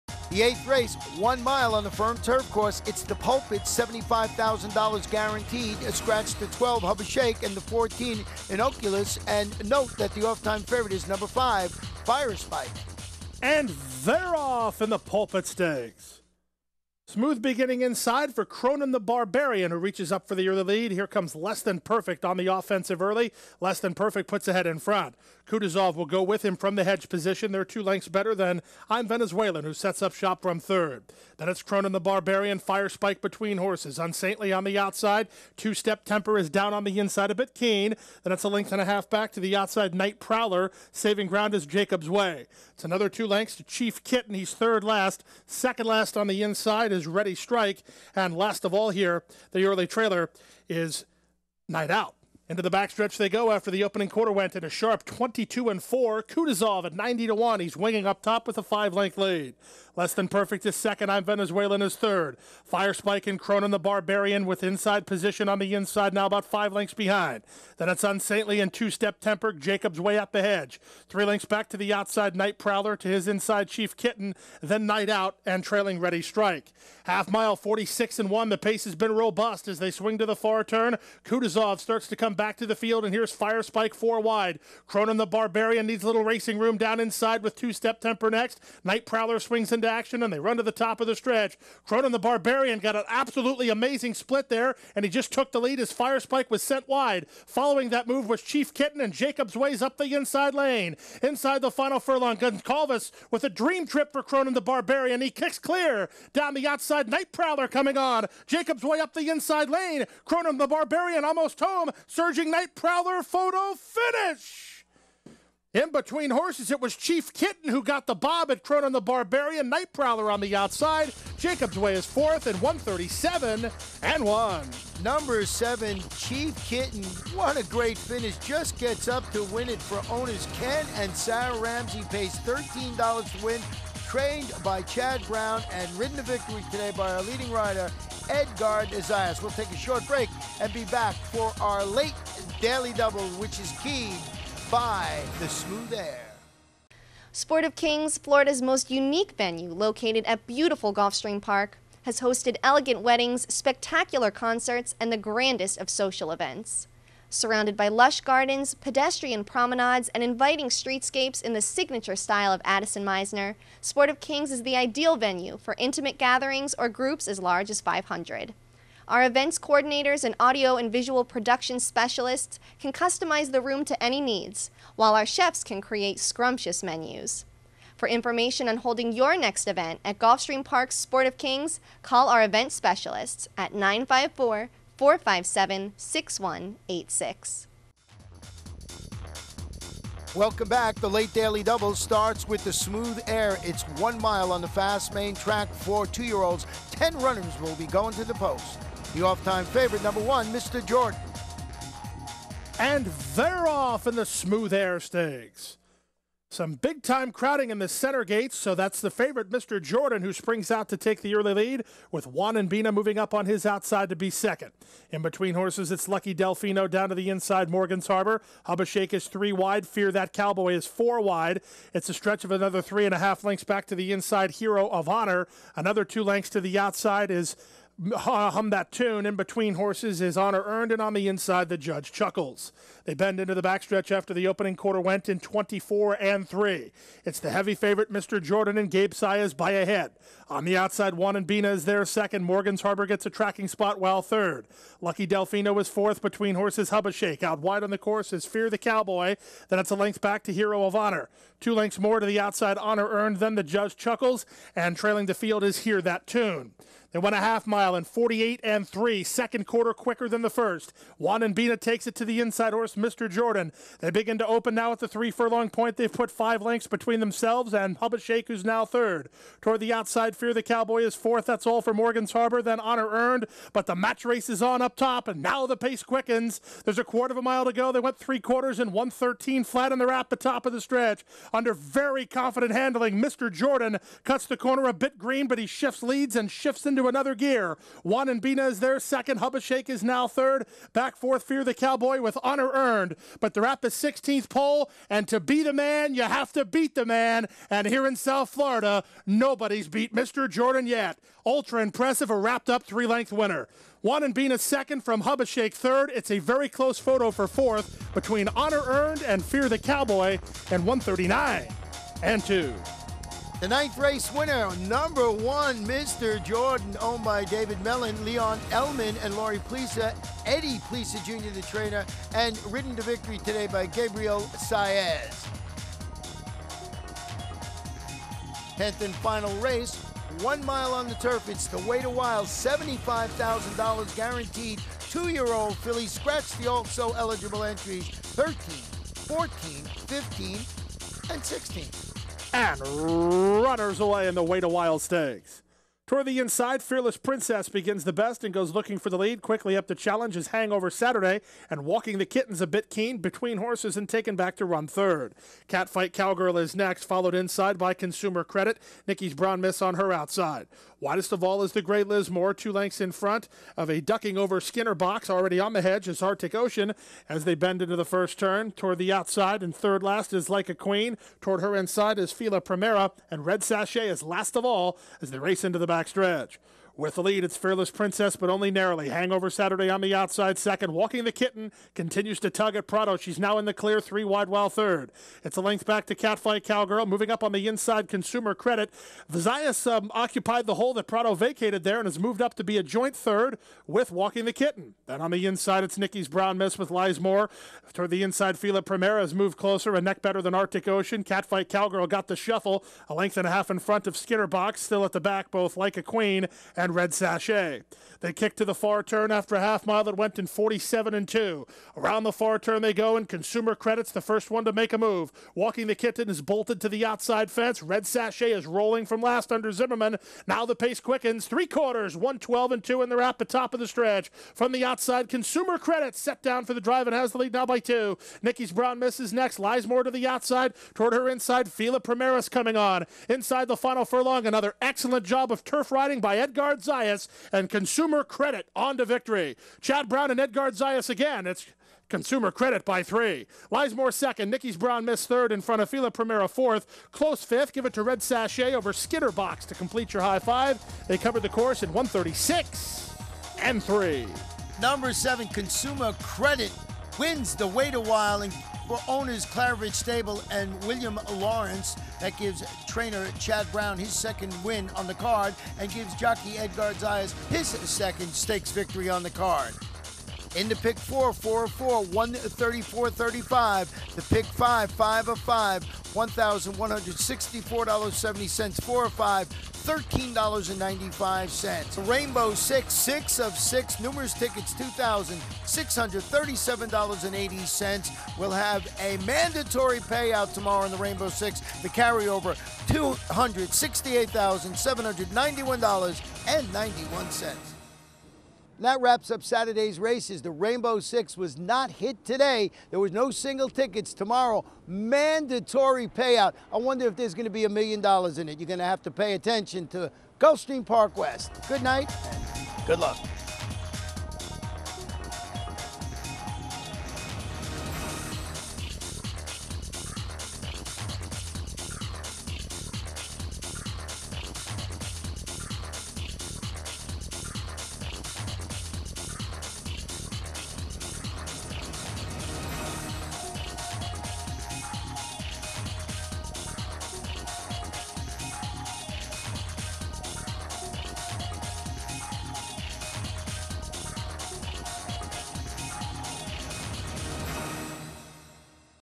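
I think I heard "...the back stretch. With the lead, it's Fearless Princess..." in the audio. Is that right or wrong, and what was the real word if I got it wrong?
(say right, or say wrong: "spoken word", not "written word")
right.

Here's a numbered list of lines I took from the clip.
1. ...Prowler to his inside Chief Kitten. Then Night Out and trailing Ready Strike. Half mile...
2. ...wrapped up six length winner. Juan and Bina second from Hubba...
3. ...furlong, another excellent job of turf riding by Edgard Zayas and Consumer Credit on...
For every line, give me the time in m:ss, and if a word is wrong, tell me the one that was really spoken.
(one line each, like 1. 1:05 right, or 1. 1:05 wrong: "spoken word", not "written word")
1. 1:12 right
2. 5:02 wrong: "three", not "six"
3. 7:14 right.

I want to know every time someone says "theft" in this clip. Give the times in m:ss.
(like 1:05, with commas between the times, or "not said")
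not said.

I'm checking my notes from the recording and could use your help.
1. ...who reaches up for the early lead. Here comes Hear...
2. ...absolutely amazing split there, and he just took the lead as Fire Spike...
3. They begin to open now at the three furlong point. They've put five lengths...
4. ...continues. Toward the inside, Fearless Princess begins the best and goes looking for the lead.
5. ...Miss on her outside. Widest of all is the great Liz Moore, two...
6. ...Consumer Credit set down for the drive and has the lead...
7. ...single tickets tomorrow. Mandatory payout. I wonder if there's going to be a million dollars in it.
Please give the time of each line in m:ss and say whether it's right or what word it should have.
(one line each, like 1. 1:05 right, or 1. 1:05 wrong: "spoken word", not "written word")
1. 0:19 wrong: "Less", not "Hear"
2. 1:33 right
3. 4:23 right
4. 5:44 wrong: "stakes", not "continues"
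5. 5:59 right
6. 7:05 right
7. 8:23 right.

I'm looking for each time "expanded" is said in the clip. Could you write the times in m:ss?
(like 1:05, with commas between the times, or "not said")
not said.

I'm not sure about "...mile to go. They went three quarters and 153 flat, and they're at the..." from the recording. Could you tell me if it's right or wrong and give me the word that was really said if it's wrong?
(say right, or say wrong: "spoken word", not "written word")
wrong: "113", not "153".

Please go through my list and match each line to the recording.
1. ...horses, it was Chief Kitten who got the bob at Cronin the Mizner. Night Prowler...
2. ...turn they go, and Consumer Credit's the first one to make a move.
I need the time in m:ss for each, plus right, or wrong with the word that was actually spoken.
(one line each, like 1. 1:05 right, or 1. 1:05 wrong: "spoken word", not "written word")
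1. 1:56 wrong: "Barbarian", not "Mizner"
2. 6:52 right.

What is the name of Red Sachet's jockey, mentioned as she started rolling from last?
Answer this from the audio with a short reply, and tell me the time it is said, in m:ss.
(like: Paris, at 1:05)
Zimmerman, at 6:59.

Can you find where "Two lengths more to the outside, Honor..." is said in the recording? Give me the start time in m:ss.
4:11.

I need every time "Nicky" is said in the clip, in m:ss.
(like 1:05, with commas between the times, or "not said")
6:35, 7:24.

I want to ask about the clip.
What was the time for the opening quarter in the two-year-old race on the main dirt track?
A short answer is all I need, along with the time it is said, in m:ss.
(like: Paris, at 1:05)
24 and 3, at 3:55.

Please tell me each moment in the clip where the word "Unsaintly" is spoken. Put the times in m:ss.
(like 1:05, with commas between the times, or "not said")
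0:33, 1:08.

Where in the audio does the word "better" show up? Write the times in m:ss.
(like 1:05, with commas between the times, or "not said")
0:28, 6:40.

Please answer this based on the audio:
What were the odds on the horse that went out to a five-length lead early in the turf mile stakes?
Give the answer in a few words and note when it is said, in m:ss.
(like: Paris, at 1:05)
90 to 1, at 0:56.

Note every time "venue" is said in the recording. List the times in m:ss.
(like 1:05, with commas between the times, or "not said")
2:29, 2:45.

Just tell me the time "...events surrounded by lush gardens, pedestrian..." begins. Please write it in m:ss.
2:36.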